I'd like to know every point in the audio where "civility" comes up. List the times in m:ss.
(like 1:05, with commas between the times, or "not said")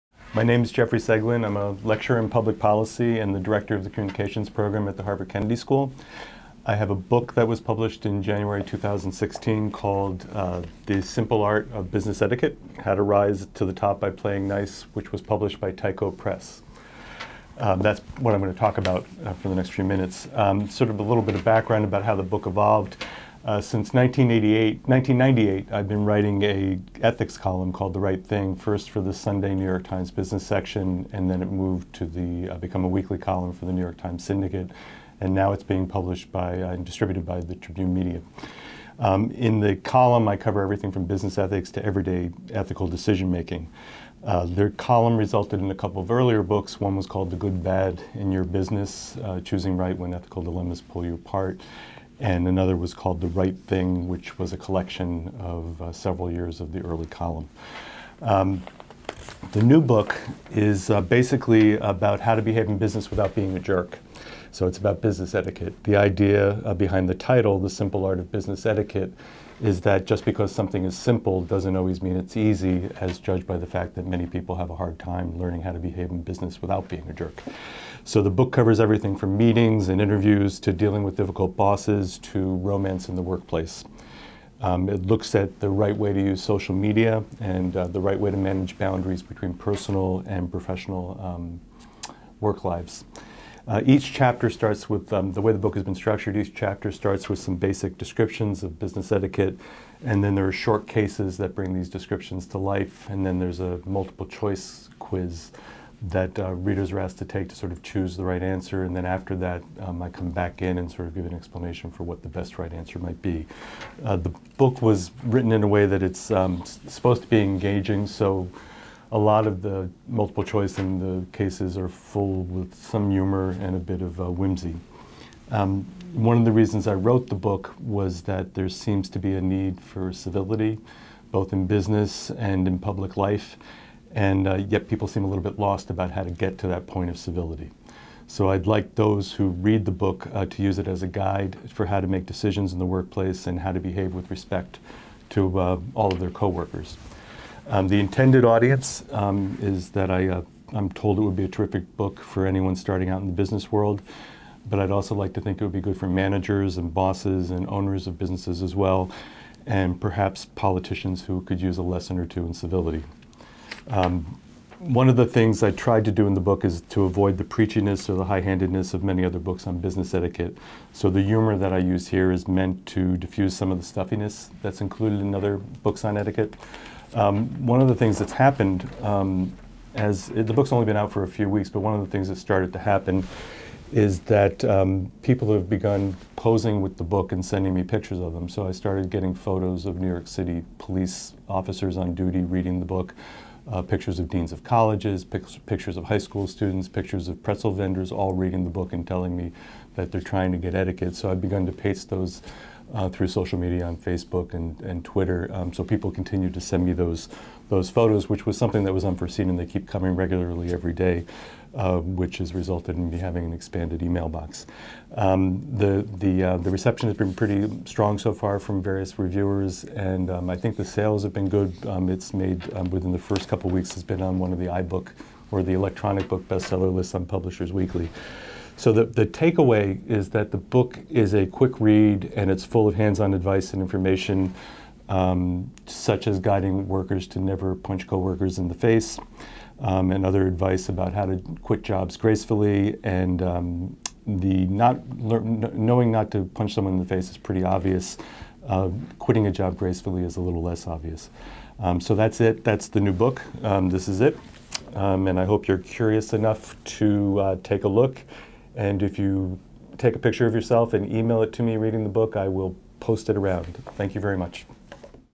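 2:10, 2:17, 2:42.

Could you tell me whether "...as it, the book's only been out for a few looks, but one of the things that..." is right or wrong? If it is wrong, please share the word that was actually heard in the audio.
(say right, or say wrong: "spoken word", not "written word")
wrong: "weeks", not "looks".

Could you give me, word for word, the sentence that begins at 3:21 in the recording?
So I've begun to paste those uh, through social media on Facebook and, and Twitter.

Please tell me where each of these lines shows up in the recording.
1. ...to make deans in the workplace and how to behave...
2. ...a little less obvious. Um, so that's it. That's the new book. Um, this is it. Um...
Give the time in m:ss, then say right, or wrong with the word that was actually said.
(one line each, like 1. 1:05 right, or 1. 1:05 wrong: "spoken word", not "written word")
1. 2:21 wrong: "decisions", not "deans"
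2. 4:10 right.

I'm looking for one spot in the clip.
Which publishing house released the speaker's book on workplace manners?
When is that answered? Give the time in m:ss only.
0:15.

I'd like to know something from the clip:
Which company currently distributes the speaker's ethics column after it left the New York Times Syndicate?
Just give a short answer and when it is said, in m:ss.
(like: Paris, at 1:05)
Tribune Media, at 0:37.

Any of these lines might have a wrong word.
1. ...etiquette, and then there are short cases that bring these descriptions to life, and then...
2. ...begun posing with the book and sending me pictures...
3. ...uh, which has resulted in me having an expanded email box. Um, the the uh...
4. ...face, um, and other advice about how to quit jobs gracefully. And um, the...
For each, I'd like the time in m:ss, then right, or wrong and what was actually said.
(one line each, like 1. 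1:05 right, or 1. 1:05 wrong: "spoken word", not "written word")
1. 1:39 right
2. 3:05 right
3. 3:31 right
4. 3:58 right.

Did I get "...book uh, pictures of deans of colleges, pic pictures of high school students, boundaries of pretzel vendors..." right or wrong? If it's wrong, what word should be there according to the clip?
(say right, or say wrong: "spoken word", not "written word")
wrong: "pictures", not "boundaries".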